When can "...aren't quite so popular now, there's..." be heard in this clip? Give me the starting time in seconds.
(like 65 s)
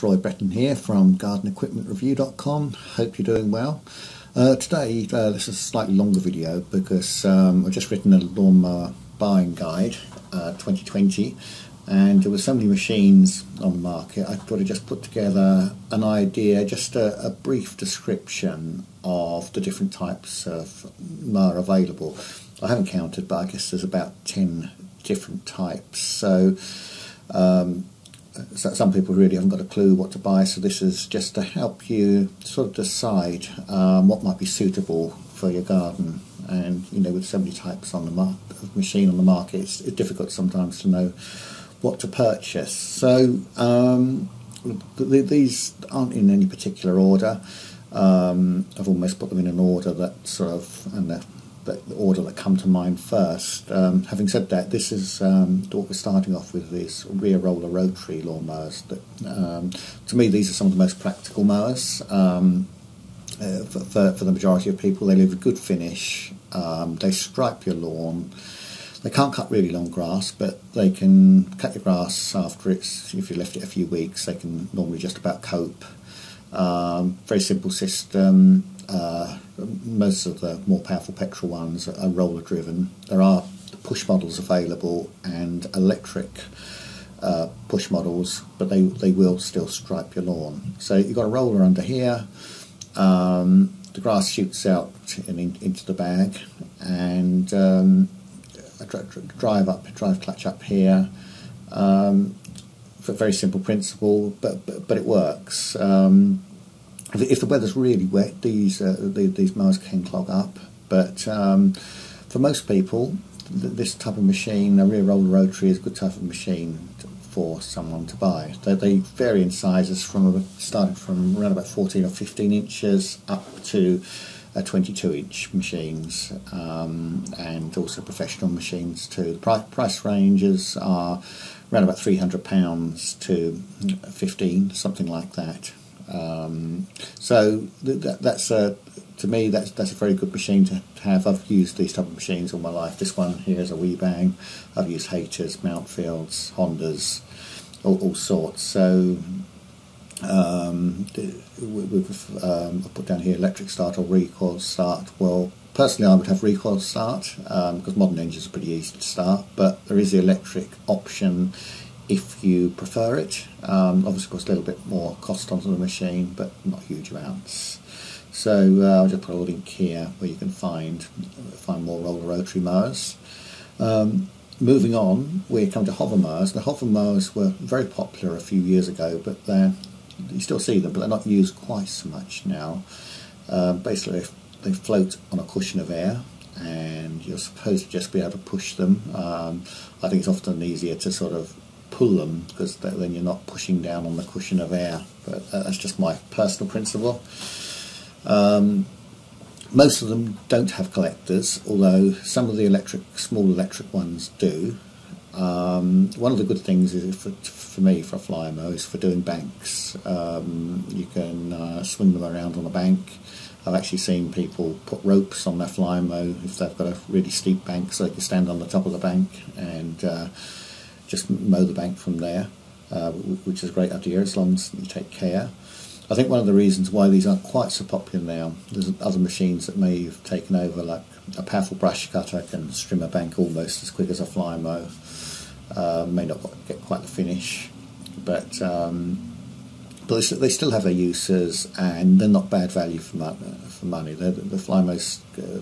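227 s.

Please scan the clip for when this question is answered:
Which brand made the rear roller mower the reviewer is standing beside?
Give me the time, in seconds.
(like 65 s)
143 s.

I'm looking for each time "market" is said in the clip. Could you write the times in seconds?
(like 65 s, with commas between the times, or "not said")
13 s, 39 s.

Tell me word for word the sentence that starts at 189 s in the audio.
Um, I think it's often easier to sort of pull them because then you're not pushing down on the cushion of air.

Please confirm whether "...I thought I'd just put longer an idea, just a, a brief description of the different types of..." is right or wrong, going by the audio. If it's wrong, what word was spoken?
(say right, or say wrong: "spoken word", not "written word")
wrong: "together", not "longer".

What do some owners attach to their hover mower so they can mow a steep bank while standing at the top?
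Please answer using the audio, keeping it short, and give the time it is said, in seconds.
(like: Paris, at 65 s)
Ropes, at 215 s.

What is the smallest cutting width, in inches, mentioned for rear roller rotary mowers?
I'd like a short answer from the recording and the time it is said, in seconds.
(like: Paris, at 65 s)
14 inches, at 121 s.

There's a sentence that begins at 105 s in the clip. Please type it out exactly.
Um, if the weather's really wet, these uh, the, these miles can clog up.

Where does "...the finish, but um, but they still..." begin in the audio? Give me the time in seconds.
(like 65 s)
237 s.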